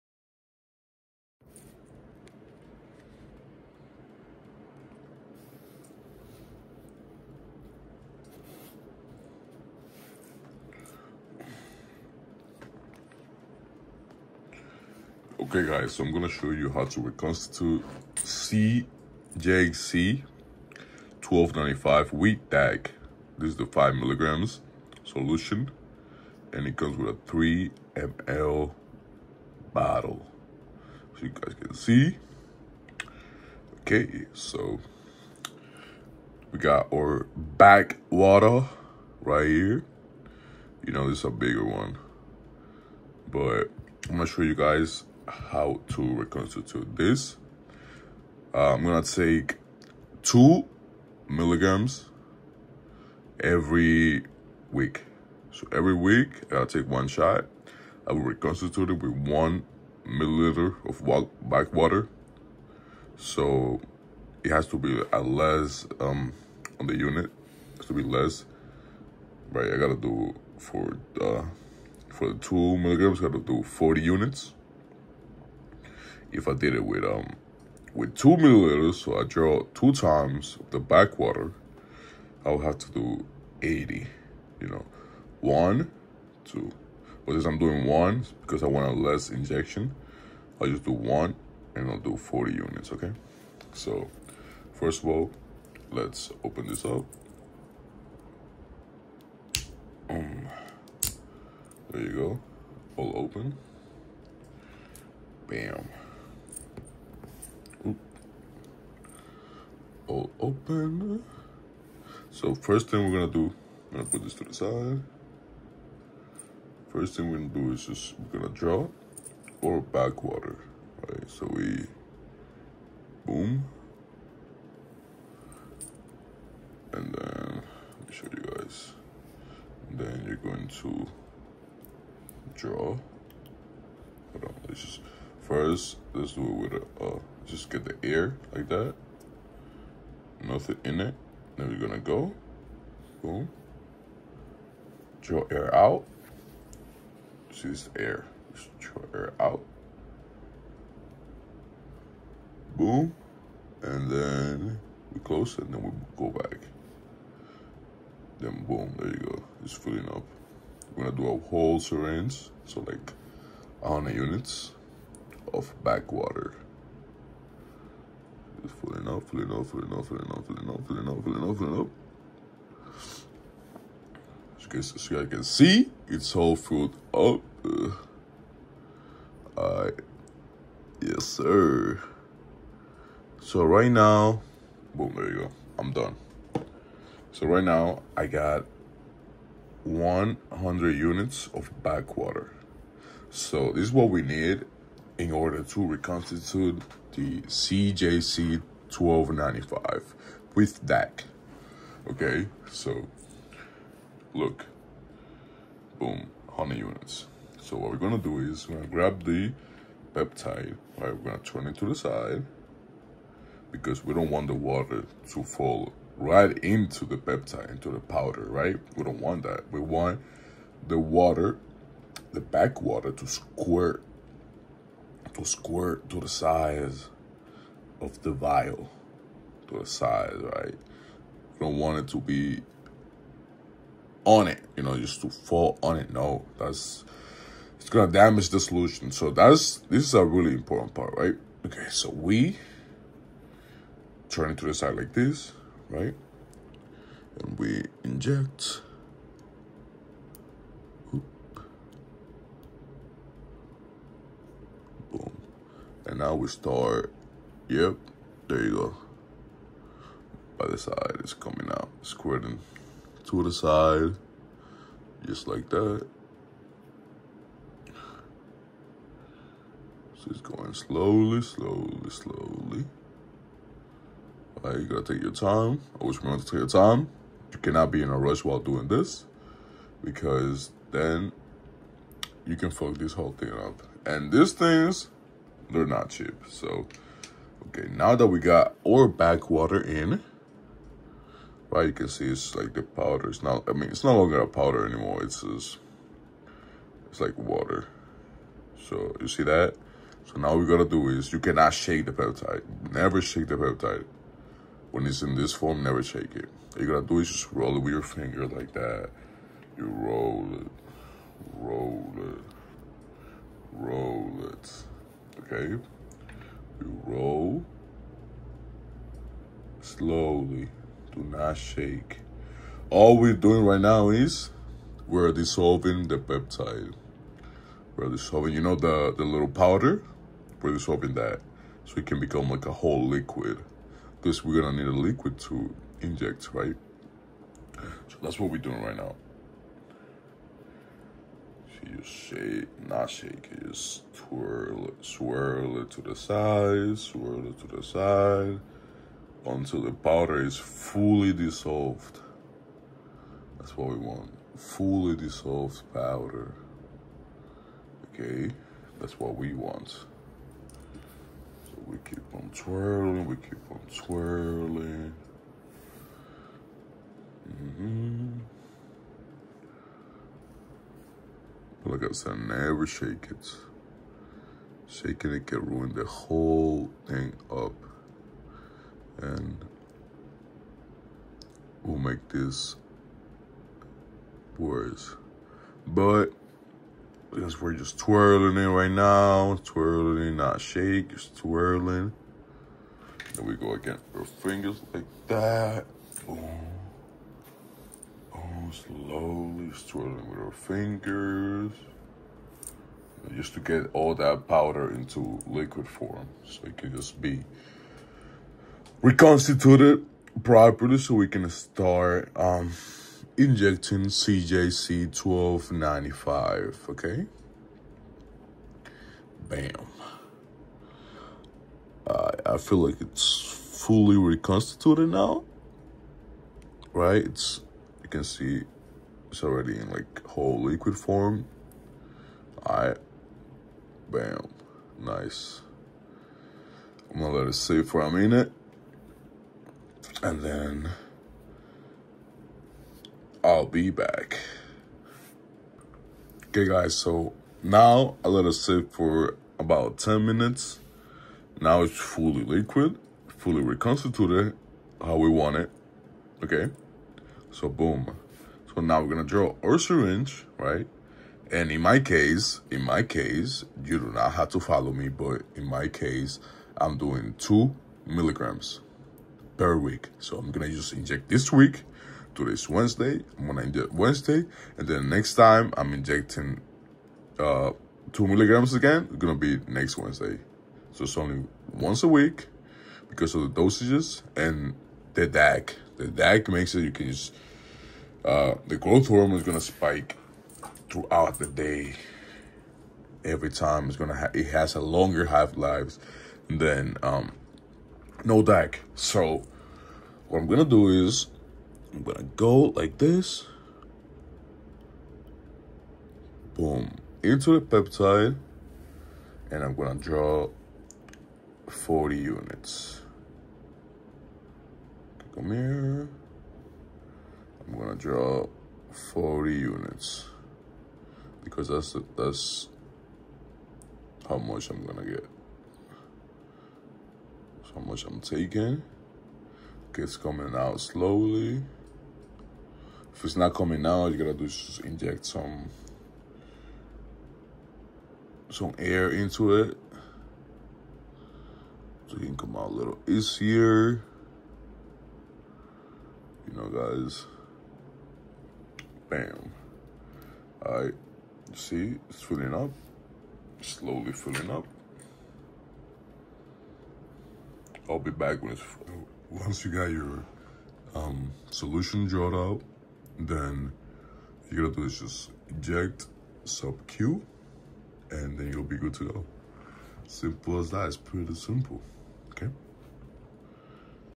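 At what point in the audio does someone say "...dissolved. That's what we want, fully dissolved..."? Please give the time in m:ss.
5:51.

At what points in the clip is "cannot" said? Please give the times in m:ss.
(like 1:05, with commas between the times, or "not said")
4:37, 5:01.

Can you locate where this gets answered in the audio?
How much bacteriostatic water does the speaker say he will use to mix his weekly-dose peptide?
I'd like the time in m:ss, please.
0:59.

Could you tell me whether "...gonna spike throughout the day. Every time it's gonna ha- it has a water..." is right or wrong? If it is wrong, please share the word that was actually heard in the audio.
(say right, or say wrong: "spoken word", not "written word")
wrong: "longer", not "water".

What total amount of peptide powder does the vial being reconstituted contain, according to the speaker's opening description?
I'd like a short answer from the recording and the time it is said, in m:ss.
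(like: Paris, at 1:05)
5 milligrams, at 0:23.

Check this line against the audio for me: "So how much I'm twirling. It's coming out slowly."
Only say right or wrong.
wrong.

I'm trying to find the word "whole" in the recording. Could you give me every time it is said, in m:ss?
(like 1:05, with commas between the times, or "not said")
2:41, 4:43, 5:32, 6:16, 7:10.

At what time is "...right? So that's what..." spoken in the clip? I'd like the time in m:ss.
5:36.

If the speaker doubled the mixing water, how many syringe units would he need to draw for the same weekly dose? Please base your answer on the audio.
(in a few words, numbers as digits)
80.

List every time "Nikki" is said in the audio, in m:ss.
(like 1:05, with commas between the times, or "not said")
not said.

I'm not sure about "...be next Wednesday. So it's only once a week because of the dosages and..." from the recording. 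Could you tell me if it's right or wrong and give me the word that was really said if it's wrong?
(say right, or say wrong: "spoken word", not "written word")
right.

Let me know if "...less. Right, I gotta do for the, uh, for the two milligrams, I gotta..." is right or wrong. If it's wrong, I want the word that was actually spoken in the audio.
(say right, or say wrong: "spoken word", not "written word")
right.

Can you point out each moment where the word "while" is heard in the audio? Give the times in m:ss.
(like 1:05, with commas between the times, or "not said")
4:38.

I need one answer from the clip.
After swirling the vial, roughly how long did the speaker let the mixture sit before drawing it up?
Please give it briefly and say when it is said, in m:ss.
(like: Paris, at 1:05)
10 minutes, at 7:29.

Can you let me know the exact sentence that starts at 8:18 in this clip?
So what I'm gonna do is I'm gonna go like this.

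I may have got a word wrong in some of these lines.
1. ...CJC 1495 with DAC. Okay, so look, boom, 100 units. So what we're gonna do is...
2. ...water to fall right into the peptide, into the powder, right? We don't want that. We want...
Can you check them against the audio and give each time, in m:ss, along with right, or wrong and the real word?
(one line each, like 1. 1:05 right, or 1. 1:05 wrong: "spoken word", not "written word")
1. 3:17 wrong: "1295", not "1495"
2. 3:34 right.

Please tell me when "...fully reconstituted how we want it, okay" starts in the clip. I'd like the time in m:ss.
7:33.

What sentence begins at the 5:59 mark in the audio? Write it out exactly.
So we keep on twirling, we keep on twirling.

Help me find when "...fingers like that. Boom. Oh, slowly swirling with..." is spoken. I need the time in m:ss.
6:34.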